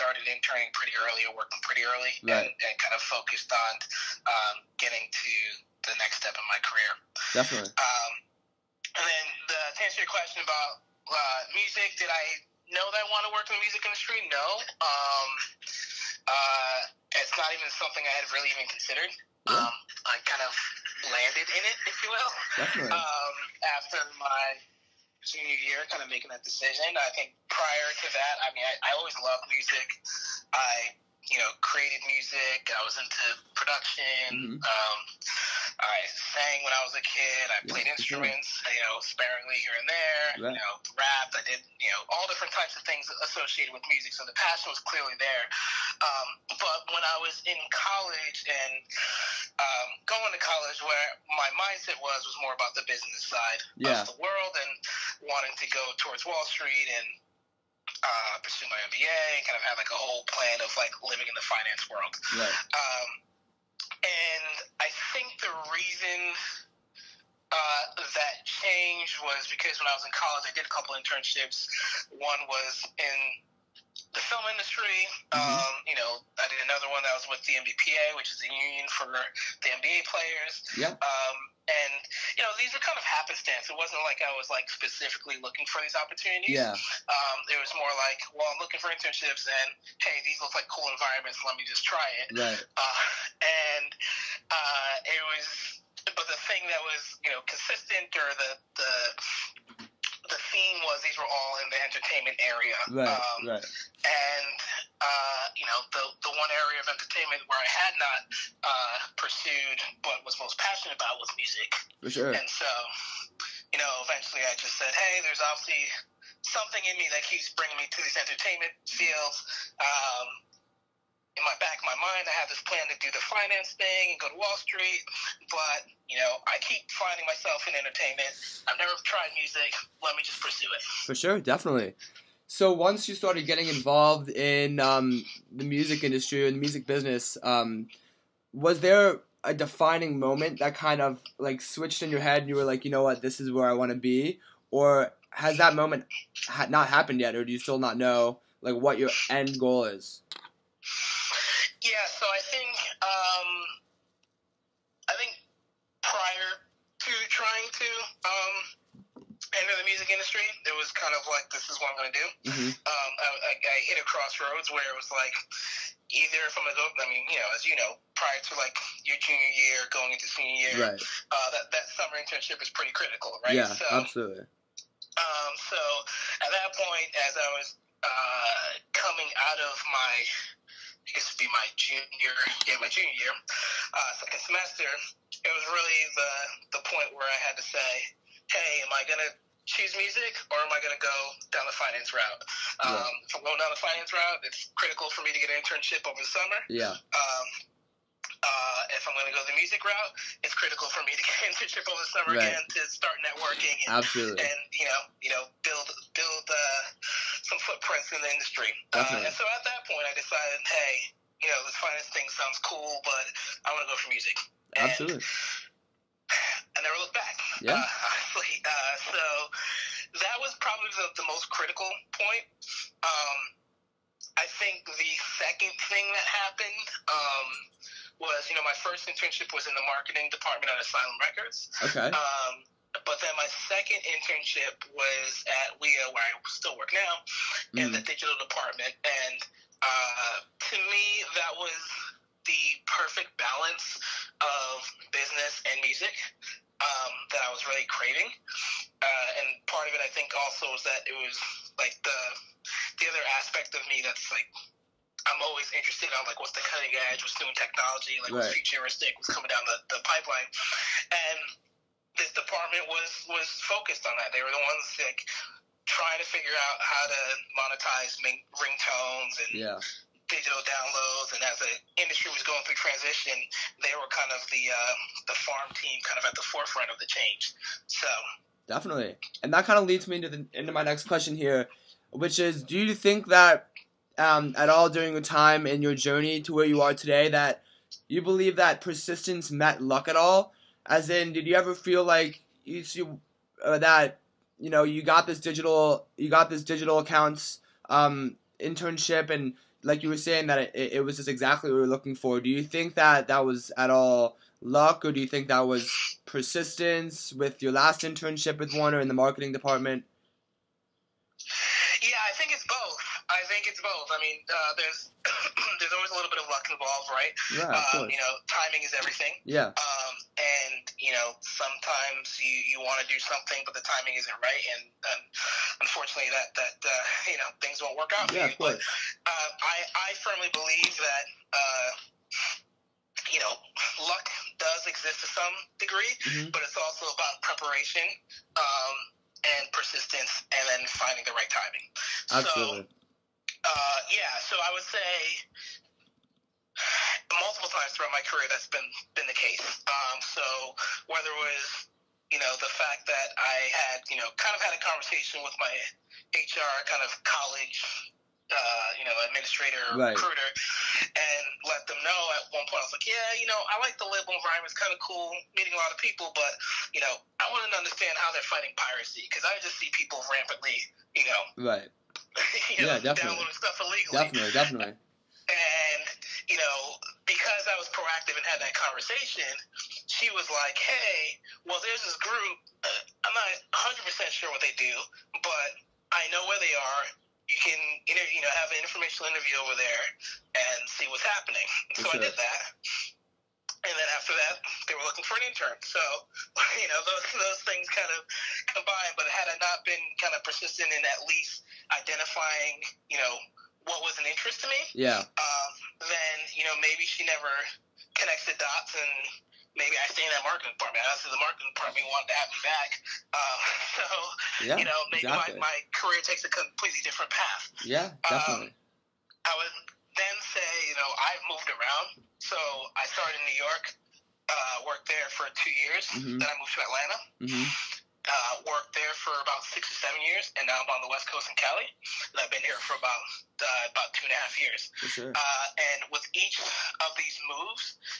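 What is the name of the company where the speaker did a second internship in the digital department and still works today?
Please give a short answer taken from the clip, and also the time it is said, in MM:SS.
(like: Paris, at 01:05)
WIA, at 03:55.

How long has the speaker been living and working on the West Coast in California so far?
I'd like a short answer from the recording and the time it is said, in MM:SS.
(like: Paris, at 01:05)
2.5 years, at 07:14.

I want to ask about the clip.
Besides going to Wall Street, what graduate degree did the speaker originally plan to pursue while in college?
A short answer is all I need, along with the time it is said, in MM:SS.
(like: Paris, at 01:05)
MBA, at 00:58.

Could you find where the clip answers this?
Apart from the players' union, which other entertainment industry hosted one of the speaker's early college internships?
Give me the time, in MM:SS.
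01:14.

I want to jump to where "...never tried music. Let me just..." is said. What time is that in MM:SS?
02:08.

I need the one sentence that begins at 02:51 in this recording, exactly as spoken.
uh, that that summer internship is pretty critical, right?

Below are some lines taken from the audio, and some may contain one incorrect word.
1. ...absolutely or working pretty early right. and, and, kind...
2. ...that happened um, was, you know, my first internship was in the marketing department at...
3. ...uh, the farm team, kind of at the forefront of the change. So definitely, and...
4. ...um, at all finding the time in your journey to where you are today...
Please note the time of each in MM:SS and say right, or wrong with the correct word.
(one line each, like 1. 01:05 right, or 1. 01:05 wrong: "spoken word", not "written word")
1. 00:01 wrong: "early", not "absolutely"
2. 03:46 right
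3. 04:34 right
4. 04:44 wrong: "during", not "finding".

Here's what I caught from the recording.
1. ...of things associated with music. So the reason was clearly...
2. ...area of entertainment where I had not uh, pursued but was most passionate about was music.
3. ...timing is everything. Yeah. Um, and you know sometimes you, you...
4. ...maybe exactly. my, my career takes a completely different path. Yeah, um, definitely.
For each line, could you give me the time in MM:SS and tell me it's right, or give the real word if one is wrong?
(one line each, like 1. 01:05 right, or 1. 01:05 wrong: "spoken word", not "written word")
1. 00:42 wrong: "passion", not "reason"
2. 01:46 right
3. 05:18 right
4. 06:55 right.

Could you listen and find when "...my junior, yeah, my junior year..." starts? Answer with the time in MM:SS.
03:01.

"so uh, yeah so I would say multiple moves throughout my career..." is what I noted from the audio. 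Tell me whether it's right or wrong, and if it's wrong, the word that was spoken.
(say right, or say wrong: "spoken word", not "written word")
wrong: "times", not "moves".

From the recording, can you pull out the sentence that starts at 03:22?
again to start networking and, Absolutely.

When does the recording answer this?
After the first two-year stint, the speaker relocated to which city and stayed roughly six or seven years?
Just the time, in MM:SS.
07:06.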